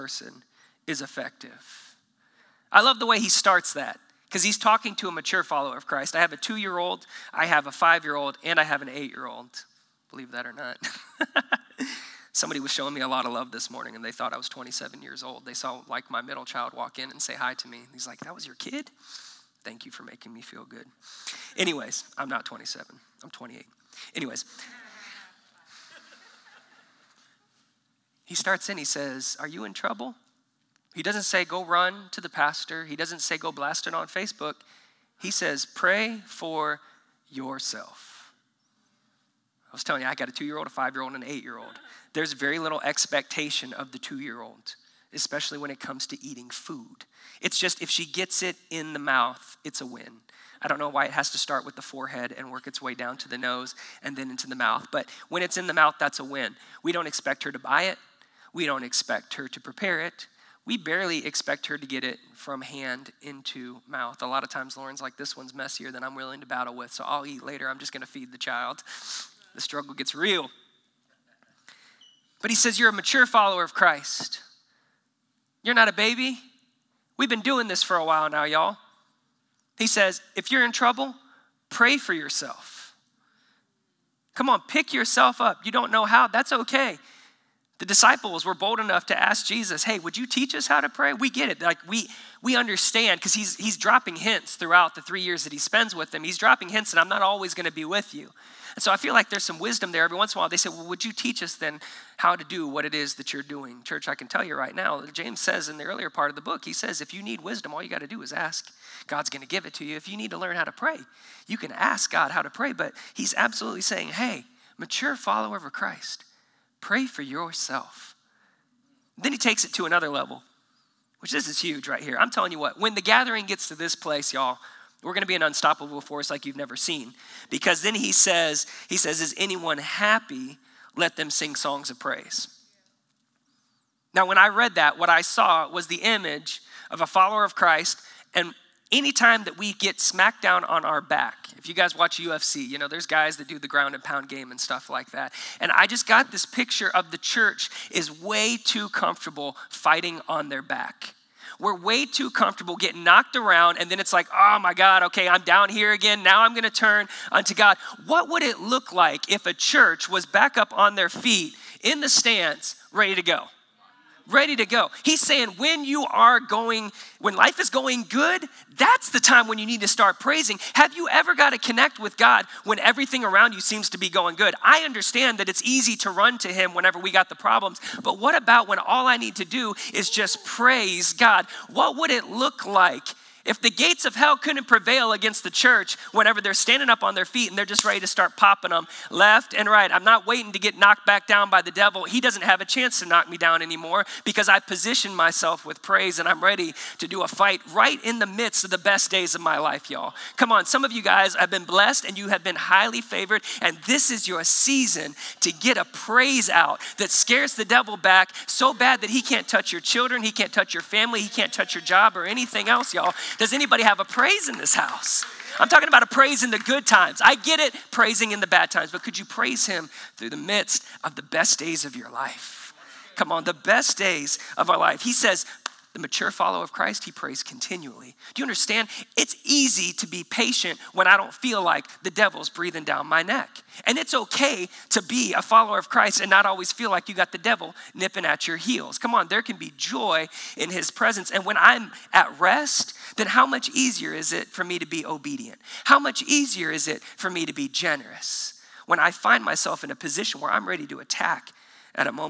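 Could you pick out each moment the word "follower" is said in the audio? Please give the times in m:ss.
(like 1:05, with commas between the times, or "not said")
0:05, 1:13, 1:55, 2:17, 3:46, 3:55.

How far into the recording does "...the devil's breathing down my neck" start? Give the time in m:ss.
3:52.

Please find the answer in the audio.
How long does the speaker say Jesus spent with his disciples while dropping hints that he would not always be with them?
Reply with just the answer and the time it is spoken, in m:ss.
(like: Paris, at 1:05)
3 years, at 1:35.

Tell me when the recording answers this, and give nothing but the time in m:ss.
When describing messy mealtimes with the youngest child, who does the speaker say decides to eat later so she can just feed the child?
1:04.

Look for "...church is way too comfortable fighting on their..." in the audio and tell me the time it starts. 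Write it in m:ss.
2:27.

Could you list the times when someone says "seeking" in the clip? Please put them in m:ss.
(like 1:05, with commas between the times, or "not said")
not said.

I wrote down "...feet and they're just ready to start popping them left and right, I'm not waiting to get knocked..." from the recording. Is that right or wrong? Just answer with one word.
right.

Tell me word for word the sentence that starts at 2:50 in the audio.
Have you ever got to connect with God when everything around you seems to be going good?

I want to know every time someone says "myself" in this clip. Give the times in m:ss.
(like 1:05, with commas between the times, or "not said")
3:15, 4:09.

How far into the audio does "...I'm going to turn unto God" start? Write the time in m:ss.
2:36.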